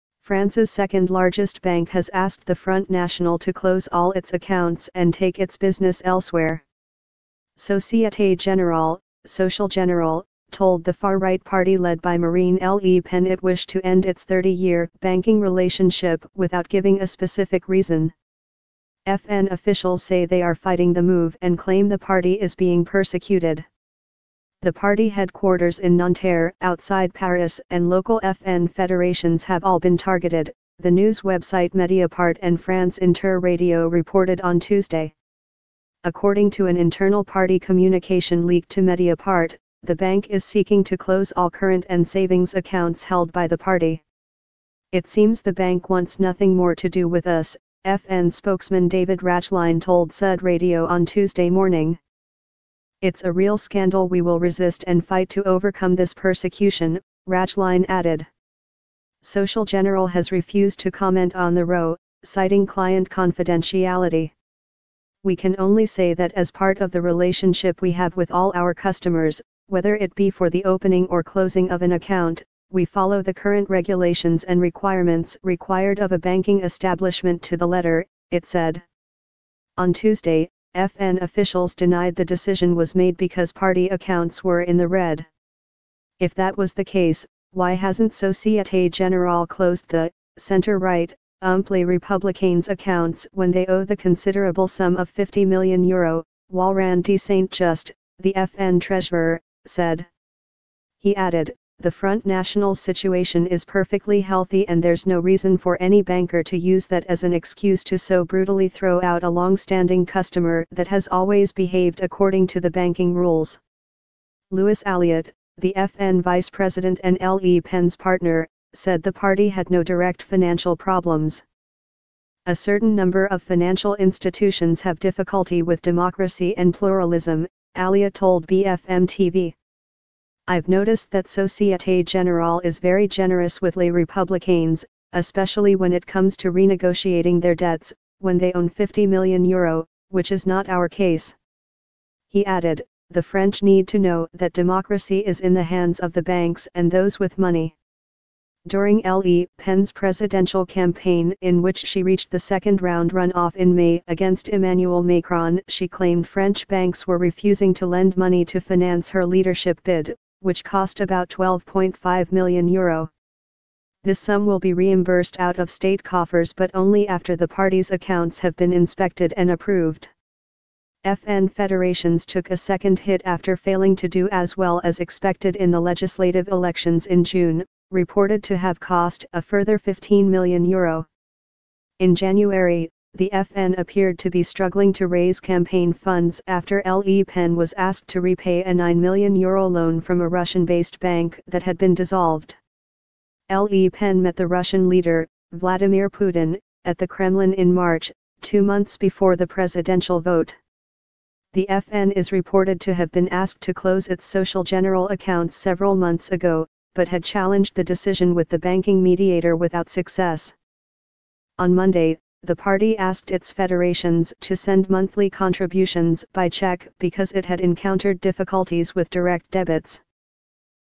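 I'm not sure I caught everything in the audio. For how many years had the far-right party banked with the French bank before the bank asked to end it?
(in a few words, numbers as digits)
30.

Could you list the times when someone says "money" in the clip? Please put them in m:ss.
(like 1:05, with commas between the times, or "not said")
2:27, 2:38.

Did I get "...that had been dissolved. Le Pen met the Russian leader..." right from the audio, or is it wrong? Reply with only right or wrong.
right.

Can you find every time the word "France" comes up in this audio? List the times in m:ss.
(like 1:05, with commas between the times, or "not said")
0:00, 0:32.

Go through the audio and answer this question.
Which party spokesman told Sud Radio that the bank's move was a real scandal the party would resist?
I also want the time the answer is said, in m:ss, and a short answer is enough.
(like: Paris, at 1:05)
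David Rachline, at 0:48.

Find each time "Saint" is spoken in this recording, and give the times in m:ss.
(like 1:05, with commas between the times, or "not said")
1:37.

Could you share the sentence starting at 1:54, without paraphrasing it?
Louis Aliot, the FN vice president and Le Pen's partner, said the party had no direct financial problems.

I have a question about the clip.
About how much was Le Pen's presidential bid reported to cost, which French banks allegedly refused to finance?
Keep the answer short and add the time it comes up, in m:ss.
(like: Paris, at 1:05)
12.5 million euro, at 2:41.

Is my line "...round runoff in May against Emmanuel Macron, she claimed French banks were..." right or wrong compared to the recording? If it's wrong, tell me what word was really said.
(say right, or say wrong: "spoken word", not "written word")
right.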